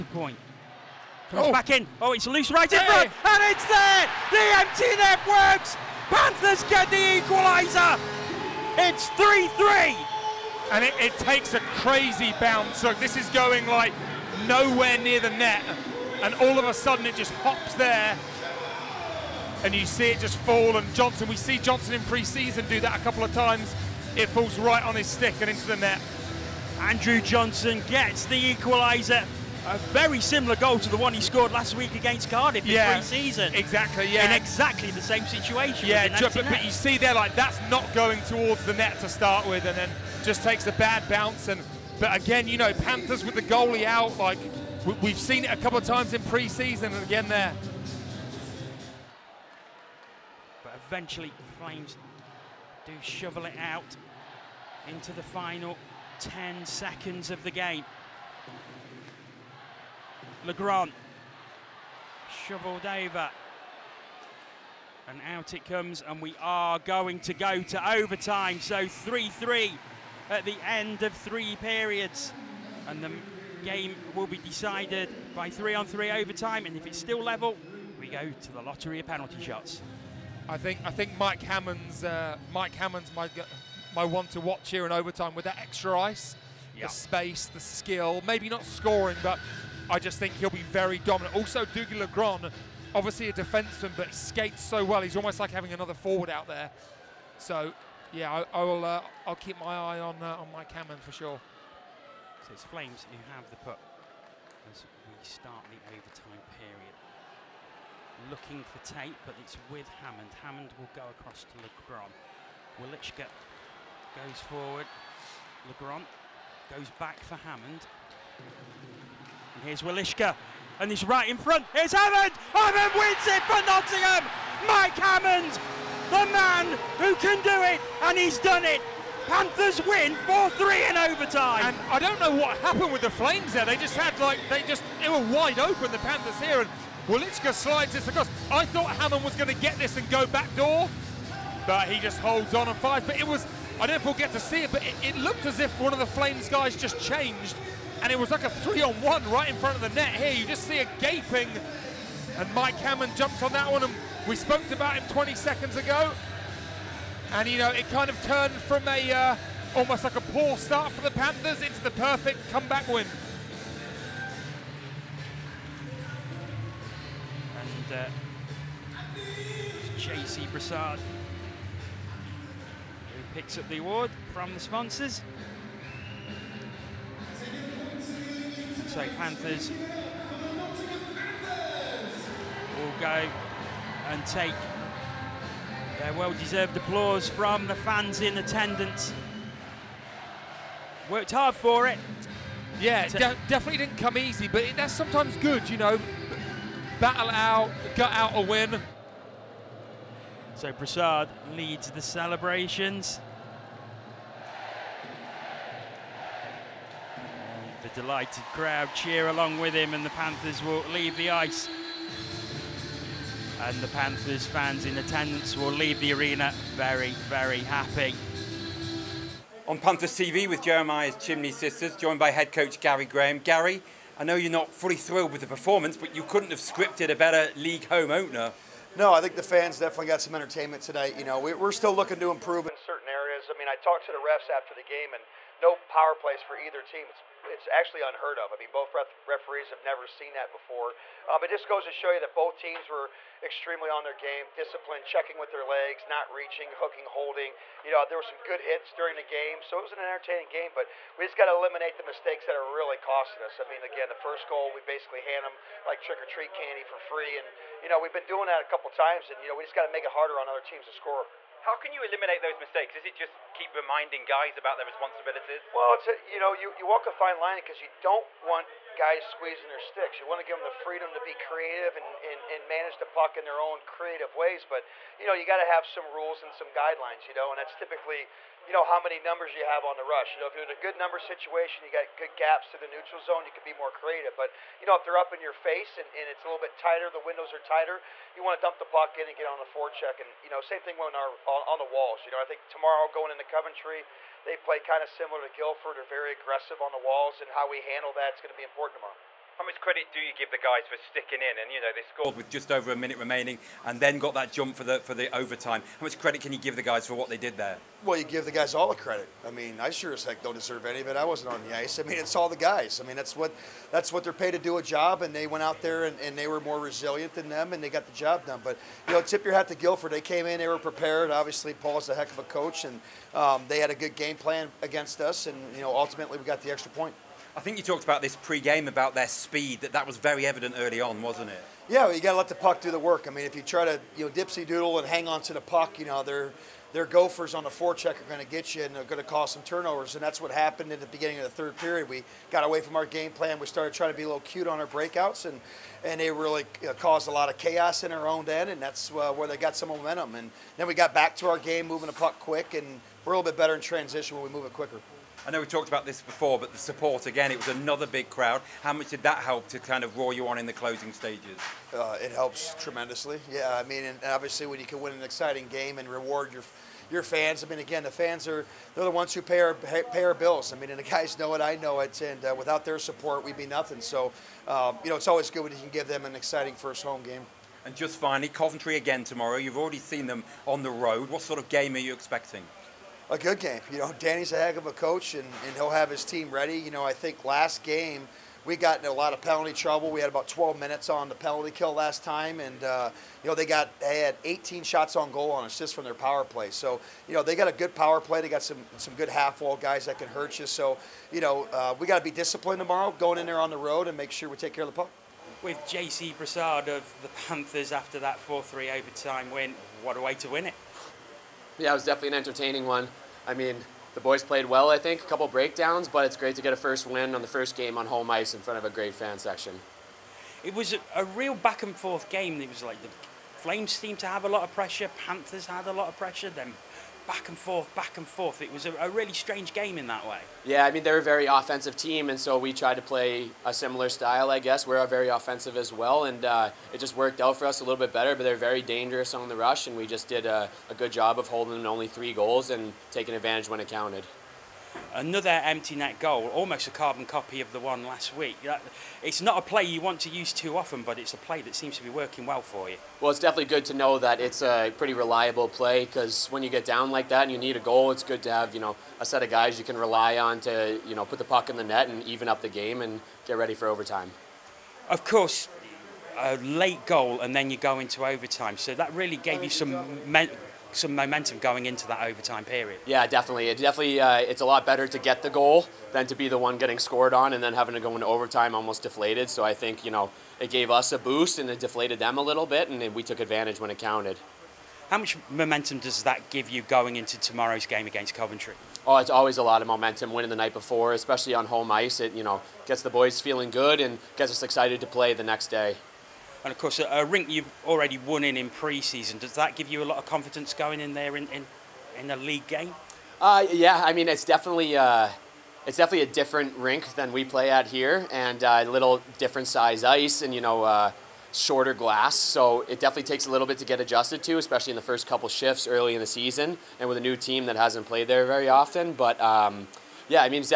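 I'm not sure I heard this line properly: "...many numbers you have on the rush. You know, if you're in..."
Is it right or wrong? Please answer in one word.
right.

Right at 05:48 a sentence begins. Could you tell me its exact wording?
And that's uh, where they got some momentum.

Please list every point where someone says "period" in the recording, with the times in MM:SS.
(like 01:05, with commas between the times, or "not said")
01:11, 01:46, 05:41, 07:52.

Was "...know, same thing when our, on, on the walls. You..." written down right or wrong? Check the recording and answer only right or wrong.
right.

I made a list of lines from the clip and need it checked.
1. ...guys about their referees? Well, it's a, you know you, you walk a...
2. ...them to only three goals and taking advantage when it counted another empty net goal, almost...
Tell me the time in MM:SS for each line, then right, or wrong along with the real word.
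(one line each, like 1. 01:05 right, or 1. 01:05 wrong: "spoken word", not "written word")
1. 04:24 wrong: "responsibilities", not "referees"
2. 07:21 right.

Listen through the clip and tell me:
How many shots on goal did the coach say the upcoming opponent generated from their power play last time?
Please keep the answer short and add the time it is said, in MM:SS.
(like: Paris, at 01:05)
18, at 06:34.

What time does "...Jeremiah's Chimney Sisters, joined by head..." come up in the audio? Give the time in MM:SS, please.
03:40.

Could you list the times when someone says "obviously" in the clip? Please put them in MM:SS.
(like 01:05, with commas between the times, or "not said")
01:32, 05:21, 06:04.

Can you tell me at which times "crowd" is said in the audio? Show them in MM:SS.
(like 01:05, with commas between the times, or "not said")
03:28, 05:58.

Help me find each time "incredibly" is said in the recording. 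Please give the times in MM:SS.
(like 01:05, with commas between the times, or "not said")
not said.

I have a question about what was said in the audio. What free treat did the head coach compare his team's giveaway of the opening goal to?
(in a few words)
trick or treat candy.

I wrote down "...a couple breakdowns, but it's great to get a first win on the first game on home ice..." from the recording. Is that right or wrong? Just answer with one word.
right.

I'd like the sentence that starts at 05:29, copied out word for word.
That that was very evident early on, wasn't it?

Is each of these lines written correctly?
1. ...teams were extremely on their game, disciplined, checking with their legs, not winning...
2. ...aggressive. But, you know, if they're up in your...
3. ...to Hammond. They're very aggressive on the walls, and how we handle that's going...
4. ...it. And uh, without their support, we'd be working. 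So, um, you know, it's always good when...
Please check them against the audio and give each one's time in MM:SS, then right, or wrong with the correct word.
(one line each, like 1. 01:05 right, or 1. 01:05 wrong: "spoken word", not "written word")
1. 04:02 wrong: "reaching", not "winning"
2. 04:43 wrong: "creative", not "aggressive"
3. 04:55 wrong: "Guildford", not "Hammond"
4. 06:12 wrong: "nothing", not "working".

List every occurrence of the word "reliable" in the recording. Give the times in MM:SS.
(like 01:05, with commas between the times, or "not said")
07:35.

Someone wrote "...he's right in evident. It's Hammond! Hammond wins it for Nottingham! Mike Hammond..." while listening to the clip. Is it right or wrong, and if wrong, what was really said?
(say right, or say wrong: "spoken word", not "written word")
wrong: "front", not "evident".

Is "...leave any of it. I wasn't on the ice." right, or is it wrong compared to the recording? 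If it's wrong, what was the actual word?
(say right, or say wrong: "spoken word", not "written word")
wrong: "deserve", not "leave".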